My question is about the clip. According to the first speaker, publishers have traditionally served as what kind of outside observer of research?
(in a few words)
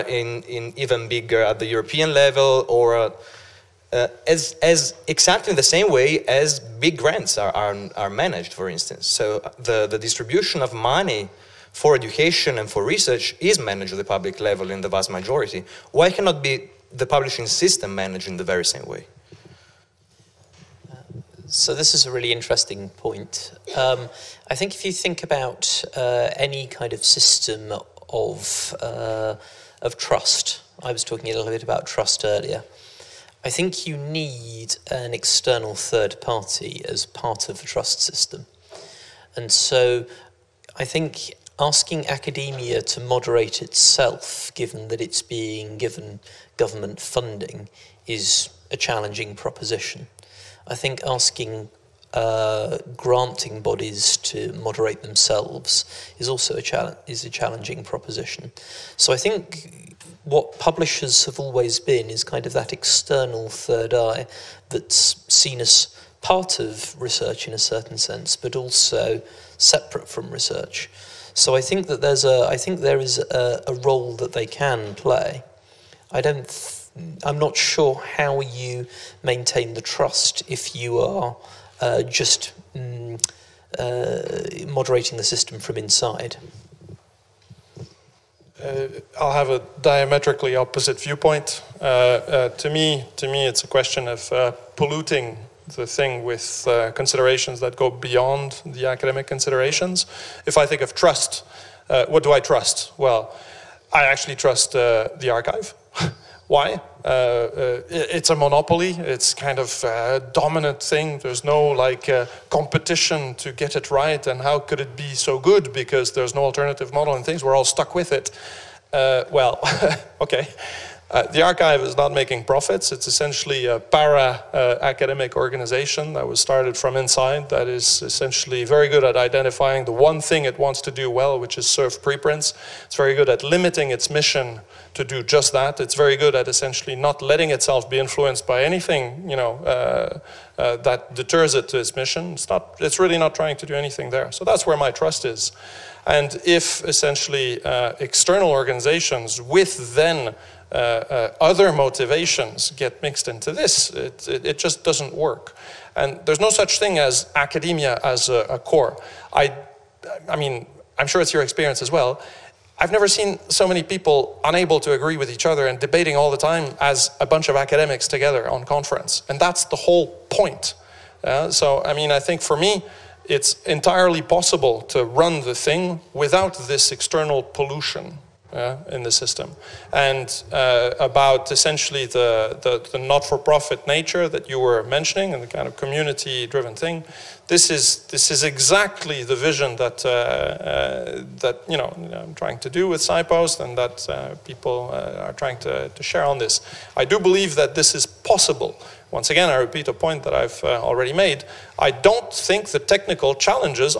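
external third eye.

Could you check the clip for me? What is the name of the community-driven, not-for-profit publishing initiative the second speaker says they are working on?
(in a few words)
SciPost.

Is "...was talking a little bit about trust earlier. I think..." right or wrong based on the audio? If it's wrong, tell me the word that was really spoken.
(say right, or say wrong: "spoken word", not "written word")
right.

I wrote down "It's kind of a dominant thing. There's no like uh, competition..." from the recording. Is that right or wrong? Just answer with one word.
right.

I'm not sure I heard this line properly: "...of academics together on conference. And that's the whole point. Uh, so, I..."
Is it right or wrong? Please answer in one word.
right.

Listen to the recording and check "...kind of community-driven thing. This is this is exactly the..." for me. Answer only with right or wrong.
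right.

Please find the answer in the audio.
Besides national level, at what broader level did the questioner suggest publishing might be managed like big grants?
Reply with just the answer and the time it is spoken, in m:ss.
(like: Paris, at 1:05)
European level, at 0:01.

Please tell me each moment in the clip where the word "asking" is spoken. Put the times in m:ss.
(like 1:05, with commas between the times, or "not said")
0:41, 0:51.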